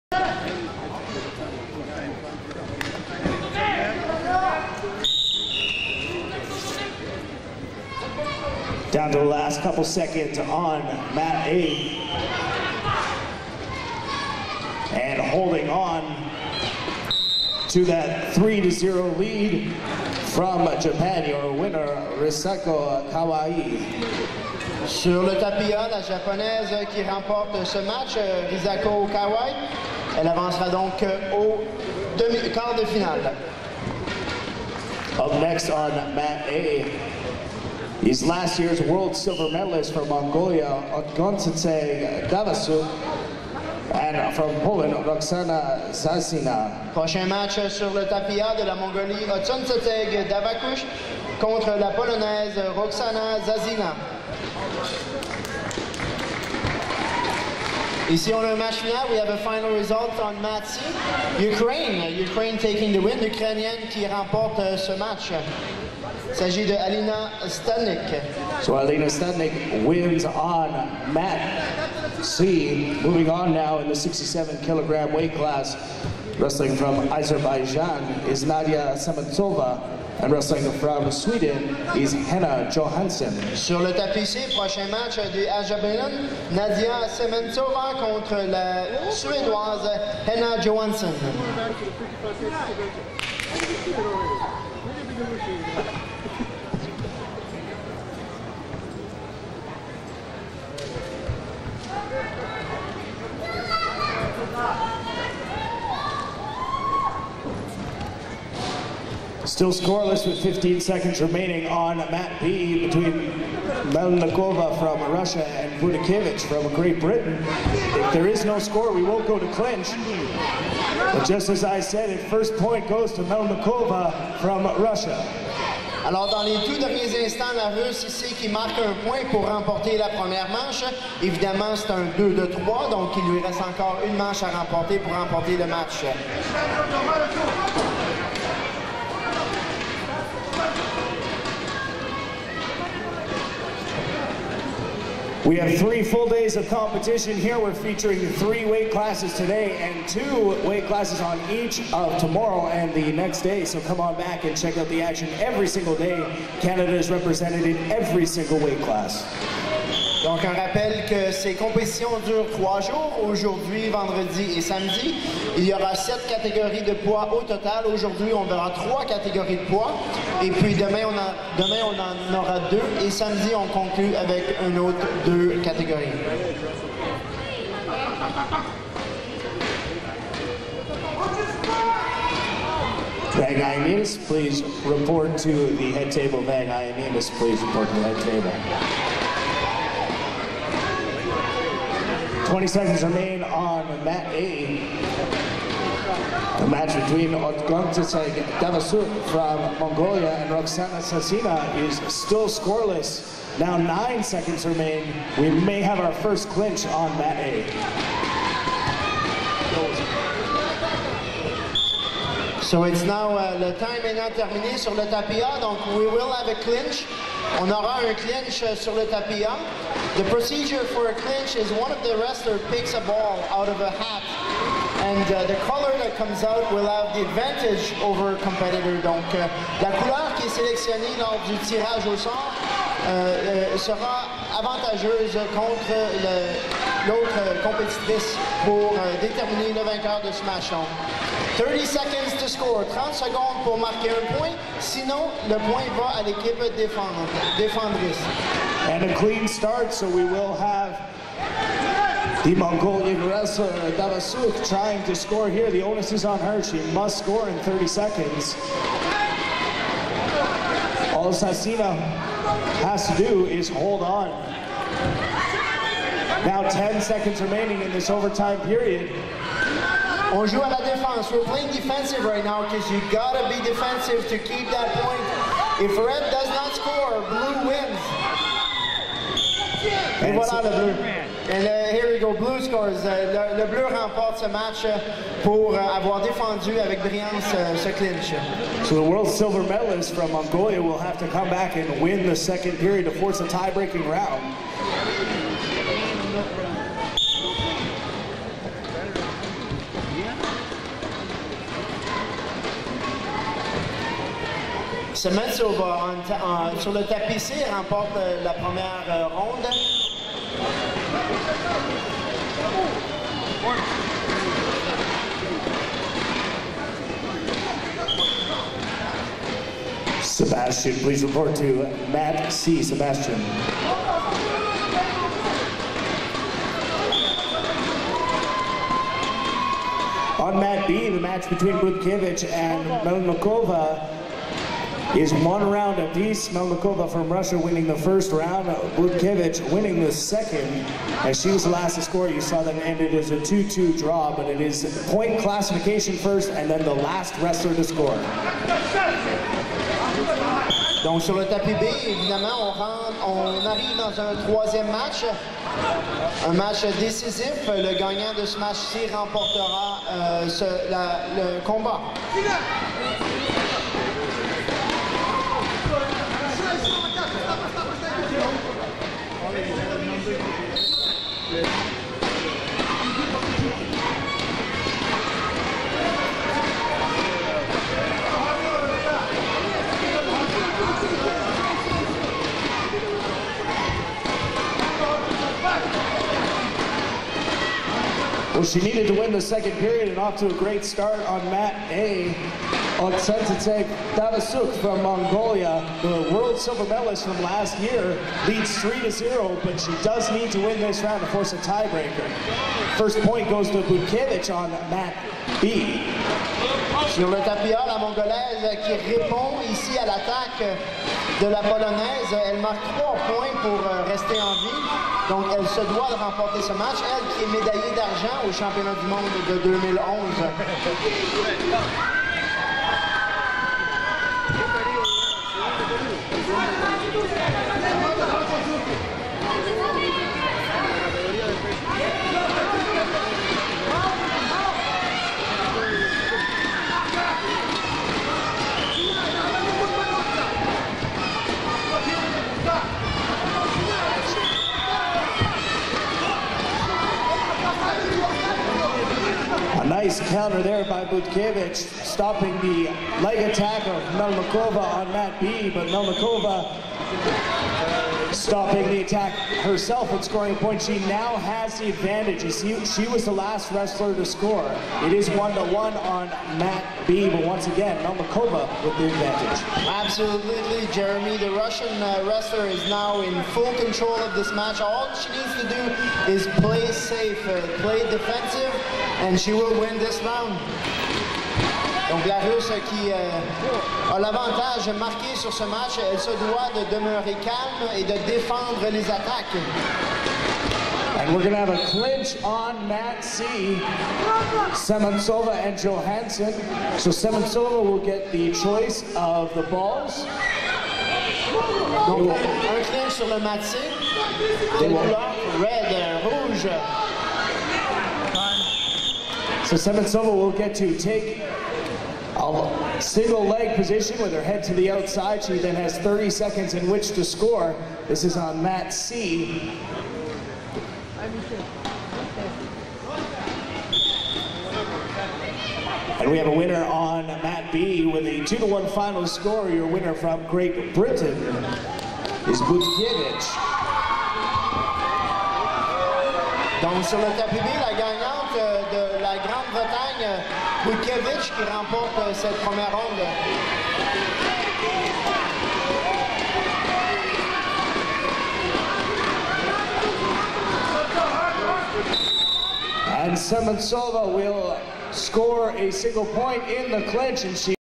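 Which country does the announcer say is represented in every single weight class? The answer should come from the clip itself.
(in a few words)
Canada.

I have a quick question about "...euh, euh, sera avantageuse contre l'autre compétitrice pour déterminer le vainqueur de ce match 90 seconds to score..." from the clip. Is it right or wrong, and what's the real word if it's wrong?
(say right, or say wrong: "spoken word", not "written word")
wrong: "30", not "90".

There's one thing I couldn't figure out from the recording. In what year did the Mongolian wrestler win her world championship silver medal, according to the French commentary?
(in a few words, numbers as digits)
2011.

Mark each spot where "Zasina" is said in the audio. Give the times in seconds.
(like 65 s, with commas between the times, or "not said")
45 s, 53 s, 200 s, 261 s.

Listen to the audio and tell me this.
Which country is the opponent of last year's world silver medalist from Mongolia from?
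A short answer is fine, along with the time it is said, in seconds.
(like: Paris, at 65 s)
Poland, at 44 s.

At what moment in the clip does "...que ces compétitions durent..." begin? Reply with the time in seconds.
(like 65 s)
161 s.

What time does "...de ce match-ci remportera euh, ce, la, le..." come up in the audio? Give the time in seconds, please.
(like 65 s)
358 s.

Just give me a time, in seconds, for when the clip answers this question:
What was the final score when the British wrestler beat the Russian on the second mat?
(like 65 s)
528 s.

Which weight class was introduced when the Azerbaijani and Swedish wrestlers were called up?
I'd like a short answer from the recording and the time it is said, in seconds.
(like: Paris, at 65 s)
67 kilograms, at 73 s.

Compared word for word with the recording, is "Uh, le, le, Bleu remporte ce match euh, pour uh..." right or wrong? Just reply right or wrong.
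right.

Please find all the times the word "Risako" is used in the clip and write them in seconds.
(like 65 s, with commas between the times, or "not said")
22 s, 28 s.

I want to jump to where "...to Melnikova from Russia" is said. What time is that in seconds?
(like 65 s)
123 s.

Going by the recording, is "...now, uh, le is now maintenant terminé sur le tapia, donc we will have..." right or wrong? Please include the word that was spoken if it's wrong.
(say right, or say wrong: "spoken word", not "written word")
right.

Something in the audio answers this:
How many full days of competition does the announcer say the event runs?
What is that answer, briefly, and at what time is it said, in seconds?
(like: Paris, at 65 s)
3, at 145 s.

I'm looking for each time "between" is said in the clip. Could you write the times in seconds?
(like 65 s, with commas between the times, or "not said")
112 s, 197 s, 331 s.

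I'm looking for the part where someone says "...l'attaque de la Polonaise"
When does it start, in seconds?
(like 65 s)
410 s.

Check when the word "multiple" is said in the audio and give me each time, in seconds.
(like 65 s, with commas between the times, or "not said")
not said.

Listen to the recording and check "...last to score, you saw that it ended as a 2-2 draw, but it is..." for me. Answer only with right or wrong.
right.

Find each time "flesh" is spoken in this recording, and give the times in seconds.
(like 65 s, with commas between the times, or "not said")
not said.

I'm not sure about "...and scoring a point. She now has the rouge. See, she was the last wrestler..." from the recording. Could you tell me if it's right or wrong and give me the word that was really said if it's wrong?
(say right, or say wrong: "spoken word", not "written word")
wrong: "advantage", not "rouge".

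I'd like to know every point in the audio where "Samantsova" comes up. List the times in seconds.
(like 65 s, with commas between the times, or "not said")
78 s, 494 s.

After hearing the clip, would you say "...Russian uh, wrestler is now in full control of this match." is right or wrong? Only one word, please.
right.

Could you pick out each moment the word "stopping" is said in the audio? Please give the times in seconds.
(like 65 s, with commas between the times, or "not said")
451 s, 458 s.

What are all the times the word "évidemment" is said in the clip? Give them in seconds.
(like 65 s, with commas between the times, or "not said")
131 s, 352 s.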